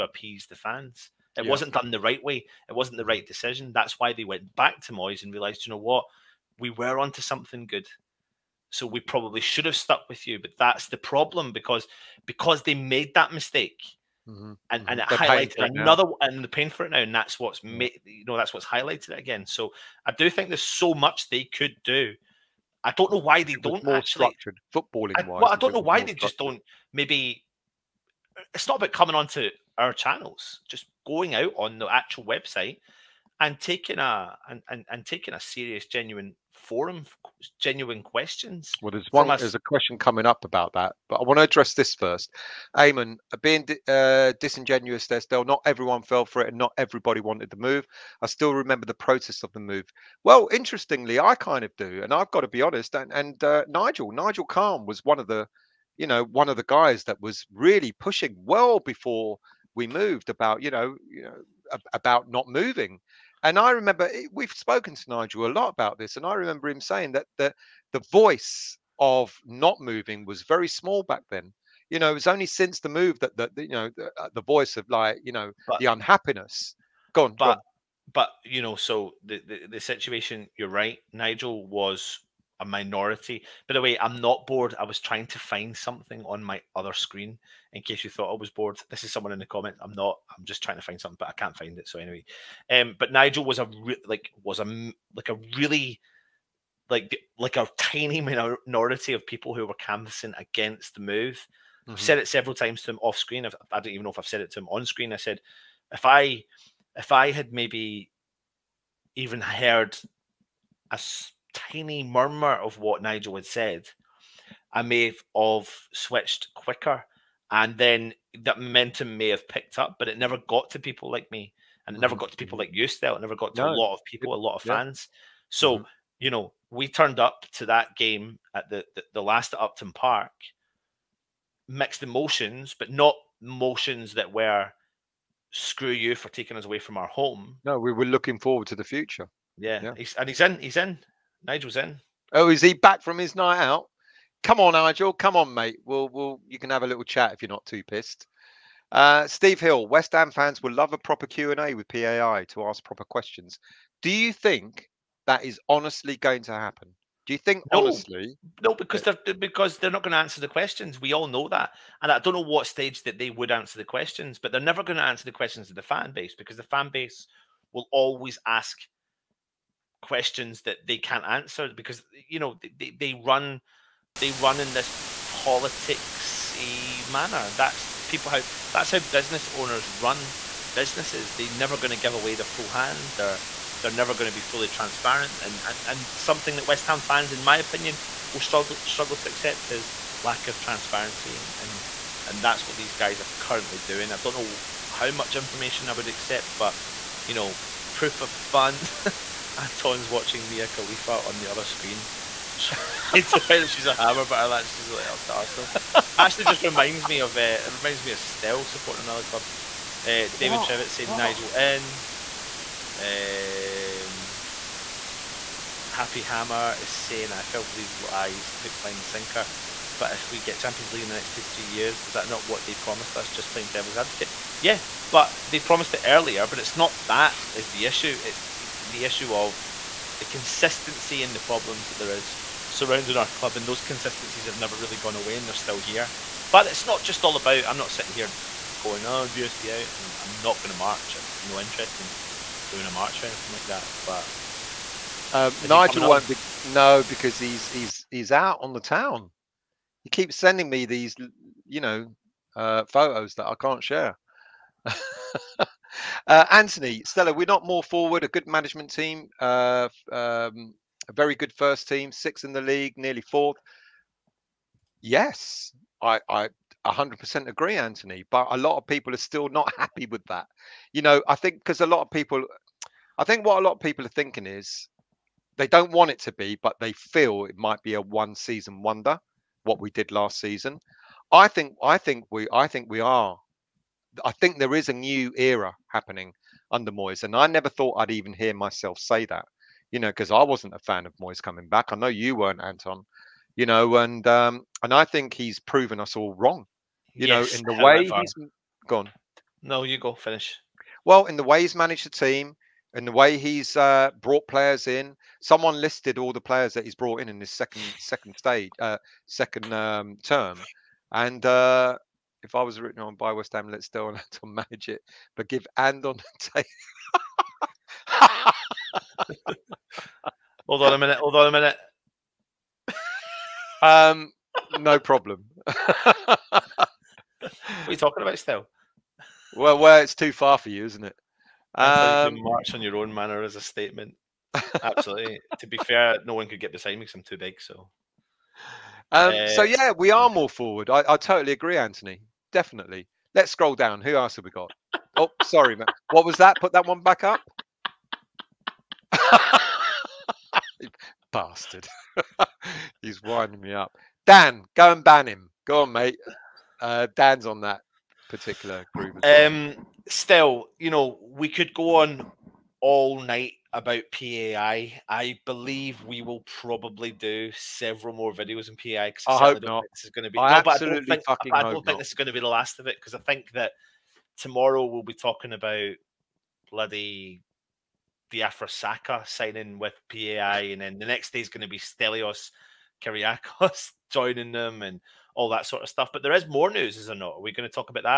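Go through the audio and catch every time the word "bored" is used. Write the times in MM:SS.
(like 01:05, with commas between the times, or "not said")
01:24, 01:28.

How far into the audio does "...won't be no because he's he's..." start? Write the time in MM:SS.
04:06.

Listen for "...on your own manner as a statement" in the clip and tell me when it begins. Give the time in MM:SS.
05:32.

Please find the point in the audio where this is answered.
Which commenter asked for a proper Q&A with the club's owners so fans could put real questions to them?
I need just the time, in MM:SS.
02:29.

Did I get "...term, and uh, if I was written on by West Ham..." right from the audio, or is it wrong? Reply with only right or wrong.
right.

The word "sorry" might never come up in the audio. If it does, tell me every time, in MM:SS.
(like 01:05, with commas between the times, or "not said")
05:45.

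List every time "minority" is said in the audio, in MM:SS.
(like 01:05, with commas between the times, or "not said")
01:22, 01:38.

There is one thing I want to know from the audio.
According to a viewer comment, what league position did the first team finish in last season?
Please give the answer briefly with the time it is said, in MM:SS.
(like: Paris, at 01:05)
Sixth, at 04:22.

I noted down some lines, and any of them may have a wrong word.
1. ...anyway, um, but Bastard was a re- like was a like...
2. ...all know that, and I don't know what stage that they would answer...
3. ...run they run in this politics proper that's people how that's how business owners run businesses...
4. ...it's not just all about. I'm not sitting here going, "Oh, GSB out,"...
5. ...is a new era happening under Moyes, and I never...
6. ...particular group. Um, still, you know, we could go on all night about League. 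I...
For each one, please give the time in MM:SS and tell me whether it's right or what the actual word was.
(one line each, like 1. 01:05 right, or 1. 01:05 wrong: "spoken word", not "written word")
1. 01:31 wrong: "Nigel", not "Bastard"
2. 02:41 right
3. 02:53 wrong: "manner", not "proper"
4. 03:56 right
5. 04:44 right
6. 05:58 wrong: "PAI", not "League".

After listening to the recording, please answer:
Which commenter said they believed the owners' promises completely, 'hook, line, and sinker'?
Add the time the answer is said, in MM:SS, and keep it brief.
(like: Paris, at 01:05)
Happy Hammer, at 03:35.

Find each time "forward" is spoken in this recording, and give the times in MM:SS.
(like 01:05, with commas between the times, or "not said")
02:18, 04:17, 05:40.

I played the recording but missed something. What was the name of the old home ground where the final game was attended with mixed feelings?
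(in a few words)
Upton Park.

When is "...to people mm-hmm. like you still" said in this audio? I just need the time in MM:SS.
02:02.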